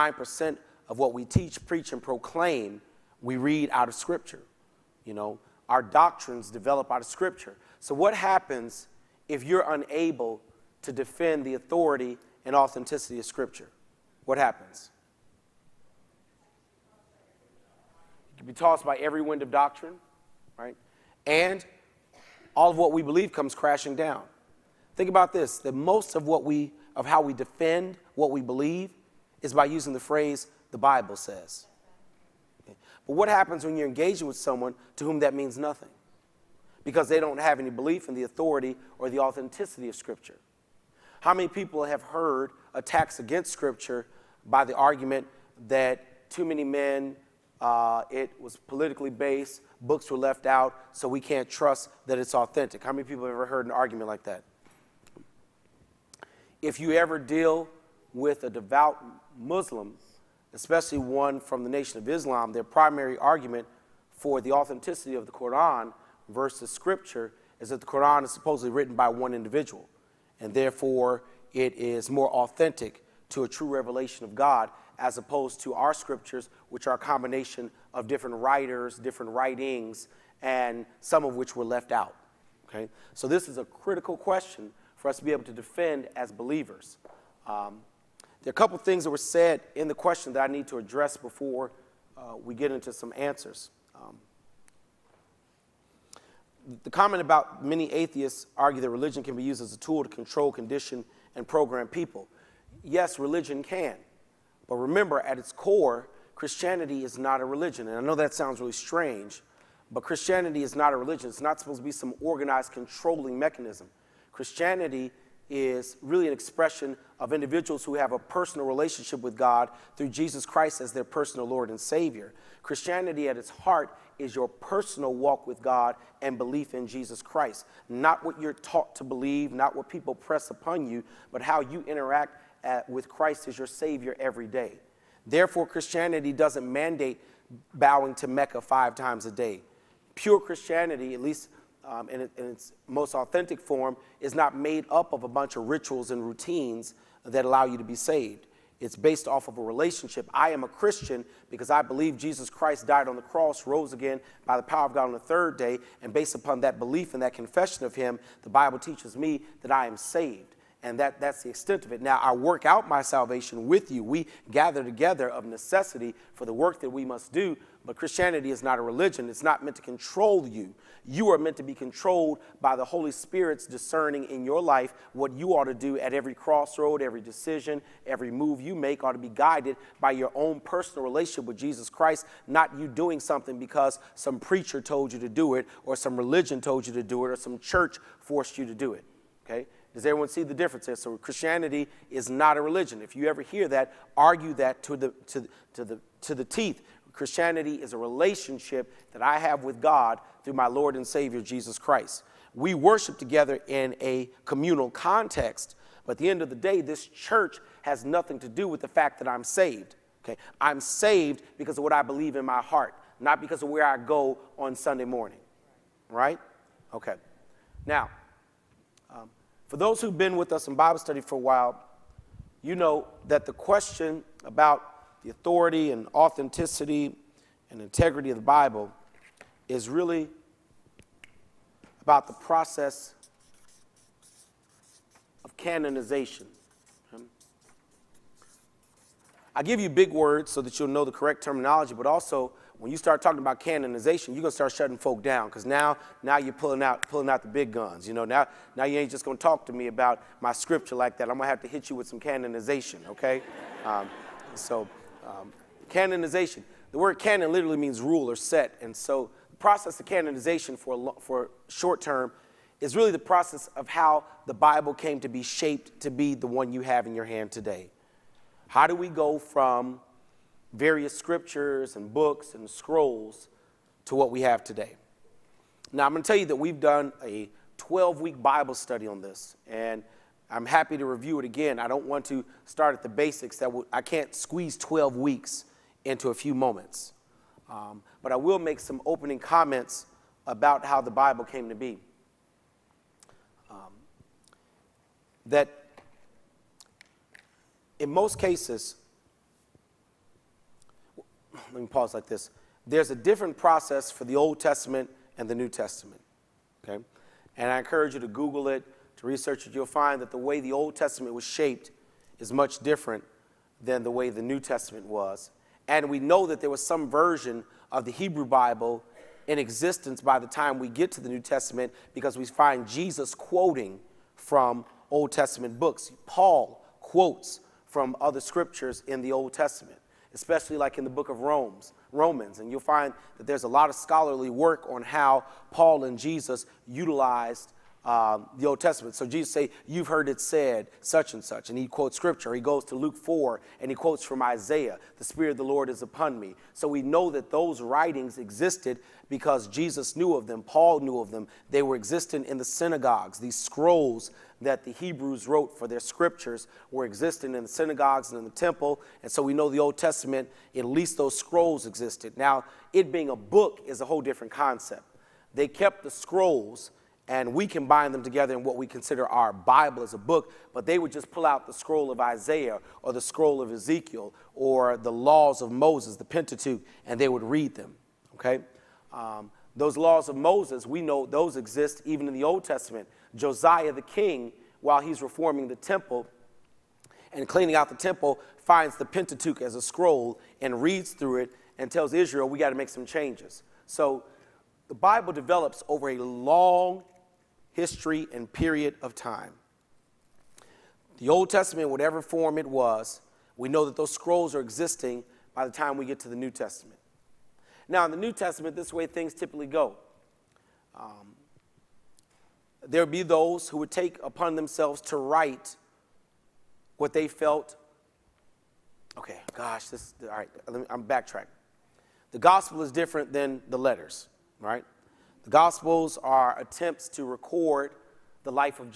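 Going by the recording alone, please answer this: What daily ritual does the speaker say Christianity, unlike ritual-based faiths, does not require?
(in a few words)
Bowing to Mecca five times a day.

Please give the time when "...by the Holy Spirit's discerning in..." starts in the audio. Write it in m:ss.
2:52.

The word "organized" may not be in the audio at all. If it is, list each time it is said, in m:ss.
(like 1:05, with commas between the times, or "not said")
1:52.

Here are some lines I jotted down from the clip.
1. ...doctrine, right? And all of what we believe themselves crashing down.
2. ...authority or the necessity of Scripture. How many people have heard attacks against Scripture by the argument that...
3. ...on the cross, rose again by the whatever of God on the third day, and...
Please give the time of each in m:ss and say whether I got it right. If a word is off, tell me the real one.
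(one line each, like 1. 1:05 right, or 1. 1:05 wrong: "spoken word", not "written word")
1. 0:19 wrong: "comes", not "themselves"
2. 0:38 wrong: "authenticity", not "necessity"
3. 2:33 wrong: "power", not "whatever".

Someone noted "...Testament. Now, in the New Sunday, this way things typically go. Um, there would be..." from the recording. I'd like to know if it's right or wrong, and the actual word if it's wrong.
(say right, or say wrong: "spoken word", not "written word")
wrong: "Testament", not "Sunday".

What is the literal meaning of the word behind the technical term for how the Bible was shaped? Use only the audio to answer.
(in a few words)
Rule or set.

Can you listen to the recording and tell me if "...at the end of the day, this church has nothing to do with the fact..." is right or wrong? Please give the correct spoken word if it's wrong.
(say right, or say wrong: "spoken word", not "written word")
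right.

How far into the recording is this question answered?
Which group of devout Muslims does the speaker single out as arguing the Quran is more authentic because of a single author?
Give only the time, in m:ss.
1:01.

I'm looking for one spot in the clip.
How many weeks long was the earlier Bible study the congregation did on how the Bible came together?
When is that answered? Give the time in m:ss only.
4:37.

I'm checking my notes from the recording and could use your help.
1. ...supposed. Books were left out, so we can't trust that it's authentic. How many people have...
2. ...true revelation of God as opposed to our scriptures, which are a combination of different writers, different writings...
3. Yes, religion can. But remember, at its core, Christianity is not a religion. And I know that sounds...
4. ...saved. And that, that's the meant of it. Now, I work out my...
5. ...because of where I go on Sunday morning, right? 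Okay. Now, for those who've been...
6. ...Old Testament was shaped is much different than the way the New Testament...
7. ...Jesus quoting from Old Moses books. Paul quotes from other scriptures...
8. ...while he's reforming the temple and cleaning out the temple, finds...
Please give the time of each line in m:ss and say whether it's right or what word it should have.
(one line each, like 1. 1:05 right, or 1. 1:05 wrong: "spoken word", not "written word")
1. 0:49 wrong: "based", not "supposed"
2. 1:13 right
3. 1:42 right
4. 2:39 wrong: "extent", not "meant"
5. 3:33 right
6. 5:10 right
7. 5:22 wrong: "Testament", not "Moses"
8. 6:24 right.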